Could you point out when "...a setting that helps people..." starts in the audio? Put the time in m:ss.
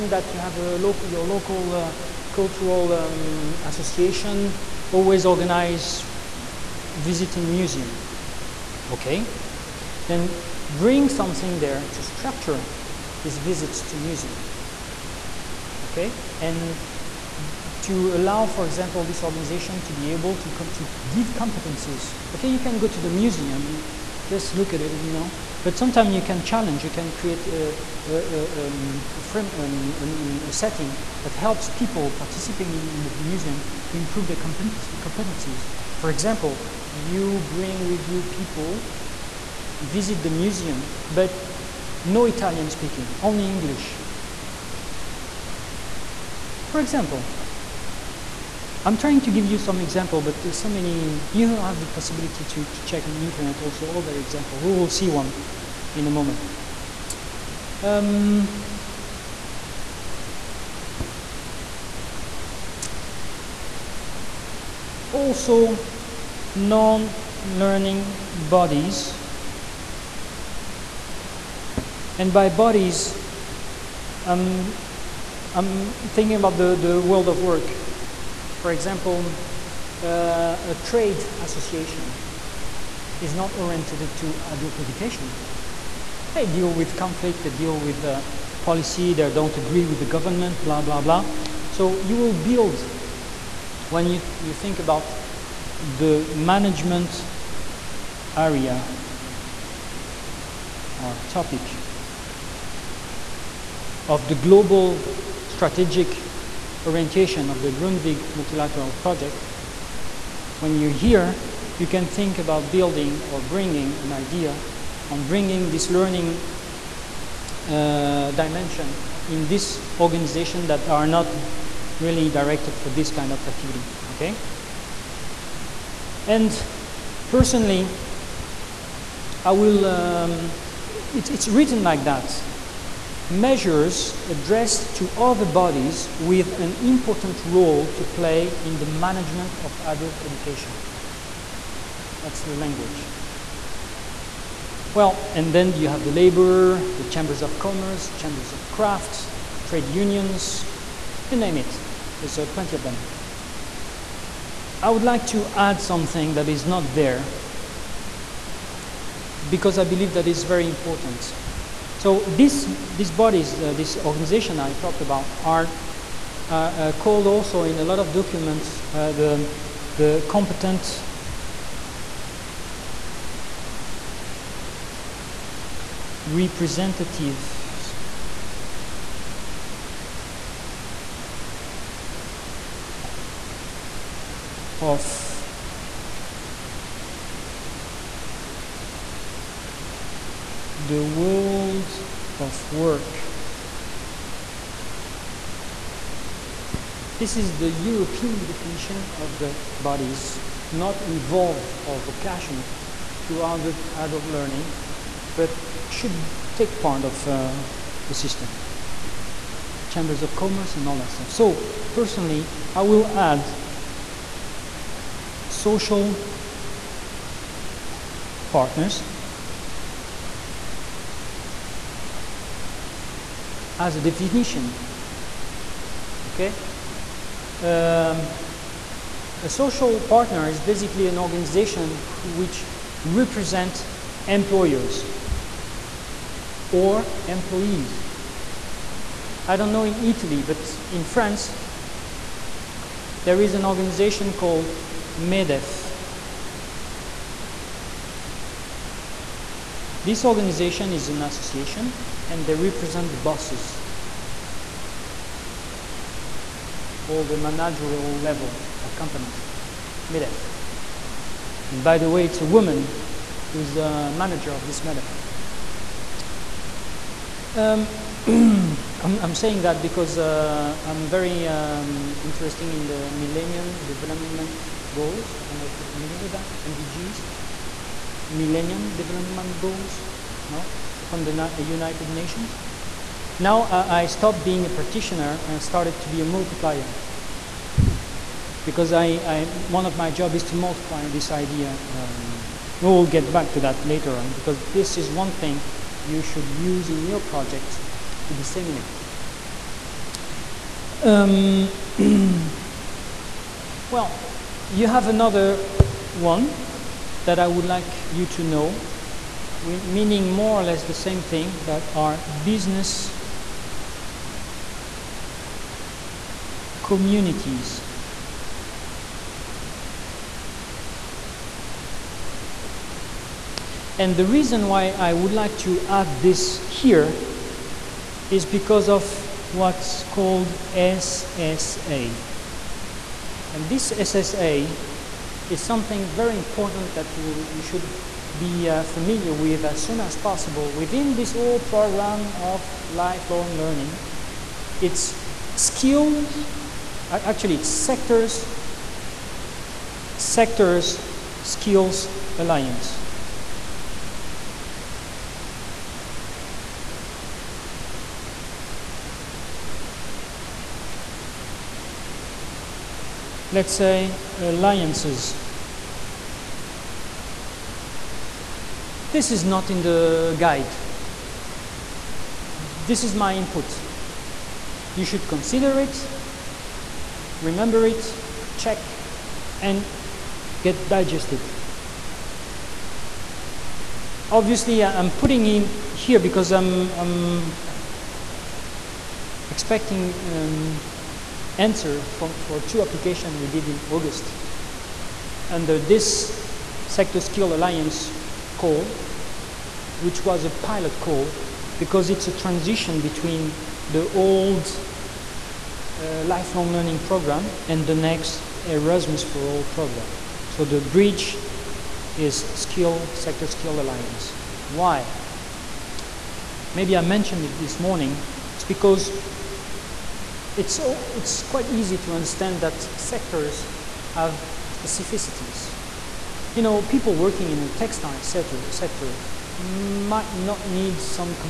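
0:30.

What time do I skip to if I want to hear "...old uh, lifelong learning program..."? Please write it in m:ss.
6:44.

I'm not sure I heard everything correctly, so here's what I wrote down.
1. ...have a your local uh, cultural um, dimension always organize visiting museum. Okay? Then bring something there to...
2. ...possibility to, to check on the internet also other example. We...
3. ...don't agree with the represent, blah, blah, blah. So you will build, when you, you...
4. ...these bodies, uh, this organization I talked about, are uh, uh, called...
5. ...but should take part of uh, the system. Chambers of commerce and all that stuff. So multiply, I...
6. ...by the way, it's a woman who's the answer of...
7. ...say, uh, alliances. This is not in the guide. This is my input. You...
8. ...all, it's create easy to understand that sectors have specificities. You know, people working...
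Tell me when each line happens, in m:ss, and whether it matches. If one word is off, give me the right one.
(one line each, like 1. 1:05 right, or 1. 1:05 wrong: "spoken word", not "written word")
1. 0:00 wrong: "association", not "dimension"
2. 0:51 right
3. 1:29 wrong: "government", not "represent"
4. 2:42 right
5. 3:25 wrong: "personally", not "multiply"
6. 4:21 wrong: "manager", not "answer"
7. 6:03 right
8. 7:00 wrong: "quite", not "create".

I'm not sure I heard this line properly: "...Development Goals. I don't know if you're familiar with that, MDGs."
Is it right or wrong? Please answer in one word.
right.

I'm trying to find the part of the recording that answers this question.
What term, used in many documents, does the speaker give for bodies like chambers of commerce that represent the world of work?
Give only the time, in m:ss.
2:50.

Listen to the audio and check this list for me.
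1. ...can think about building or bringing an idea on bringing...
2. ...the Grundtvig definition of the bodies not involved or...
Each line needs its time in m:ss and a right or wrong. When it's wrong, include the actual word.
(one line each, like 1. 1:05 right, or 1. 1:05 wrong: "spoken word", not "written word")
1. 1:51 right
2. 3:17 wrong: "European", not "Grundtvig".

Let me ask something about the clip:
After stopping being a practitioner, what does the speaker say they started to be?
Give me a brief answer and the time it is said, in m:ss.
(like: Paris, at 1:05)
A multiplier, at 4:46.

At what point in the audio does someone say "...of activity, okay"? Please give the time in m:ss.
2:03.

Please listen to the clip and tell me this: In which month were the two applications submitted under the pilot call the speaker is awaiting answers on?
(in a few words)
August.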